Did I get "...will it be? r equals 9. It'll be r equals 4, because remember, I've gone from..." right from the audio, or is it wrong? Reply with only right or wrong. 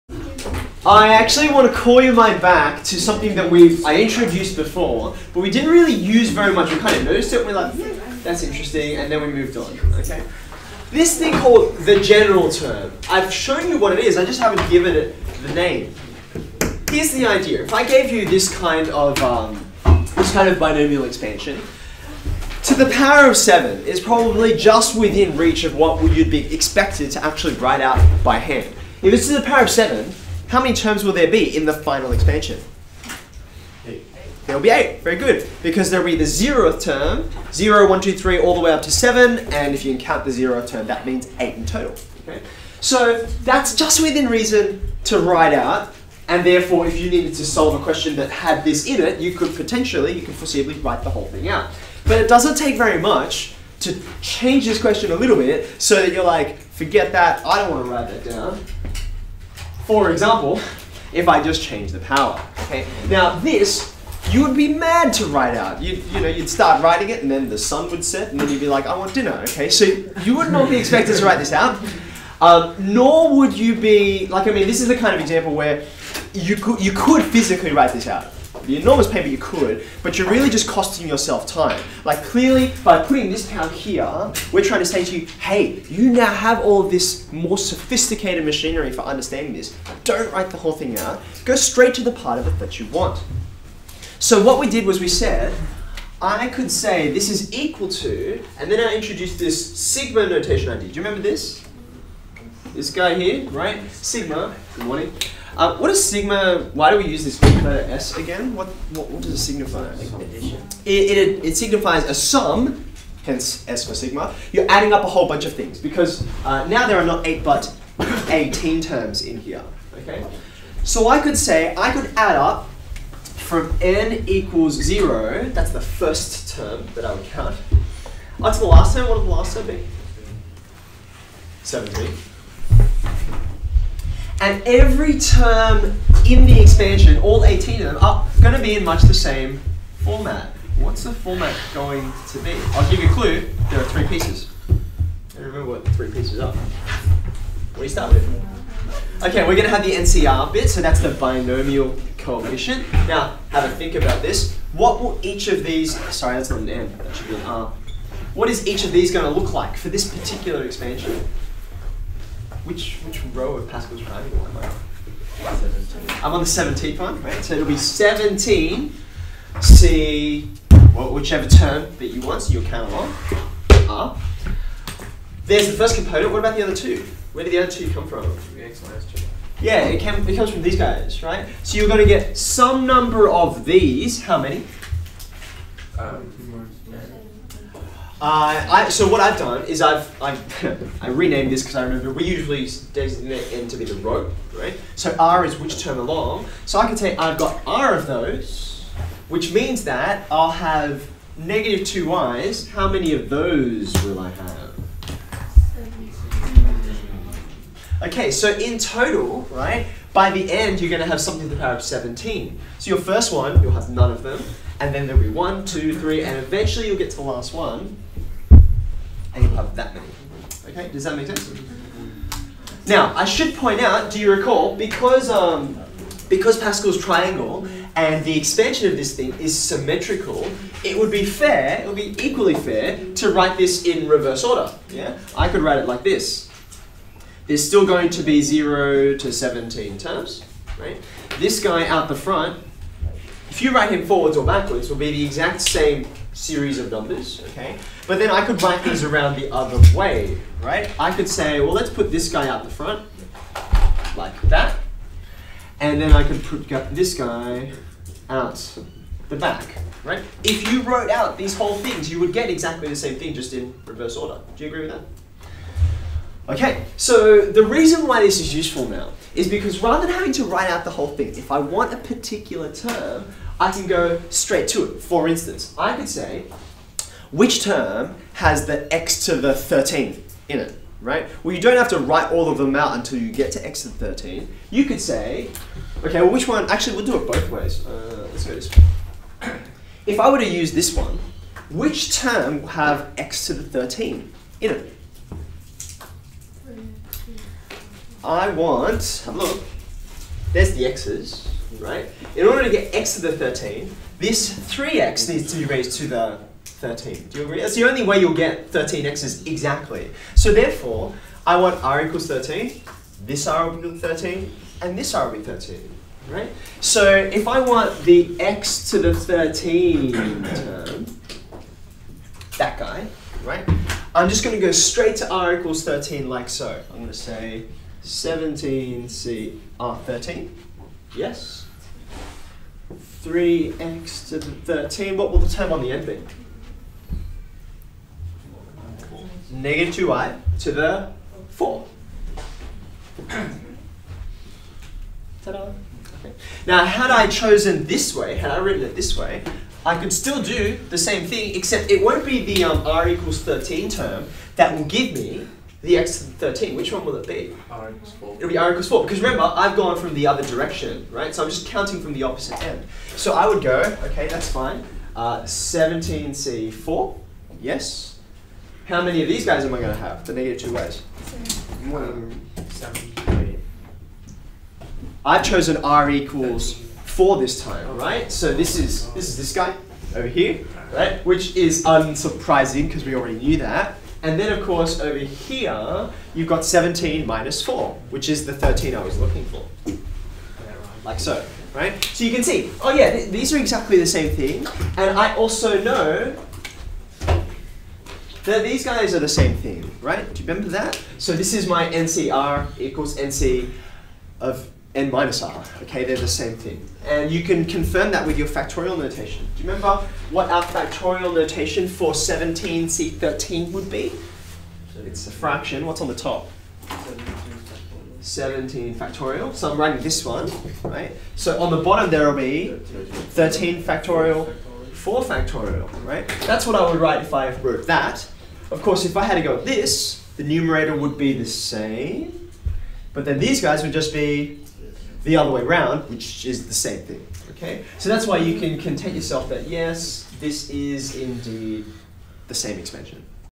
wrong.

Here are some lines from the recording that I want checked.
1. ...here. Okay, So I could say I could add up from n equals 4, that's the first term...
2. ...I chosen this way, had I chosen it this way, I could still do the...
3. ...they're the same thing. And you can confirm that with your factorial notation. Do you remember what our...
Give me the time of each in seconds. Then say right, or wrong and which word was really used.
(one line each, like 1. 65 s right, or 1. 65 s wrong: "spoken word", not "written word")
1. 119 s wrong: "0", not "4"
2. 347 s wrong: "written", not "chosen"
3. 406 s right.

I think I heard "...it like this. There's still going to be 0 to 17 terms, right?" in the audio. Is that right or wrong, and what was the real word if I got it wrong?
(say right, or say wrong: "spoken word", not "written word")
right.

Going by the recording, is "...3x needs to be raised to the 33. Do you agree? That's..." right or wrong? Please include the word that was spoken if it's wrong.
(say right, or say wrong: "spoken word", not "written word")
wrong: "13", not "33".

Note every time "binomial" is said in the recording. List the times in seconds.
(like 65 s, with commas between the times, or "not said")
20 s, 151 s.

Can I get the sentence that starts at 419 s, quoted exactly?
So I'm writing this one, right?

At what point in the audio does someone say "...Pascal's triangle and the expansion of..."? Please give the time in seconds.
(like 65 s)
226 s.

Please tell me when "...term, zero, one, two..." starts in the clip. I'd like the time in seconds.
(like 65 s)
36 s.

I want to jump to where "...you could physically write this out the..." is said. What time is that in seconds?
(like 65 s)
76 s.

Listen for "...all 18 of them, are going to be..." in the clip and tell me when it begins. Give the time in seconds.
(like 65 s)
137 s.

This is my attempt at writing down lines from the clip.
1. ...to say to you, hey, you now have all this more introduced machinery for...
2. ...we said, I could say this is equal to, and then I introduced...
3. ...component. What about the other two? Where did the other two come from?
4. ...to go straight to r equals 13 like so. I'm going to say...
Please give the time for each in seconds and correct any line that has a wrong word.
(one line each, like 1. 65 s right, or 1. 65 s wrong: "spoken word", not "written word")
1. 84 s wrong: "sophisticated", not "introduced"
2. 94 s right
3. 175 s right
4. 324 s right.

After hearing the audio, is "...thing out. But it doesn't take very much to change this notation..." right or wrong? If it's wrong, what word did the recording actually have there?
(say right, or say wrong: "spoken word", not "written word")
wrong: "question", not "notation".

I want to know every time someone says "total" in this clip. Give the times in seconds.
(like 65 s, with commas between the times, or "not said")
41 s, 208 s.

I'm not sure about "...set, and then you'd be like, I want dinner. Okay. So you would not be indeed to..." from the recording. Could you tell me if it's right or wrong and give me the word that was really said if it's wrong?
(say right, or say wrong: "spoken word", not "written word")
wrong: "expected", not "indeed".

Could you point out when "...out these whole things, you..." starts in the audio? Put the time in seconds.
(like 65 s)
261 s.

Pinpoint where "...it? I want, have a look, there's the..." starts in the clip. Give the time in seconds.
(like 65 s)
294 s.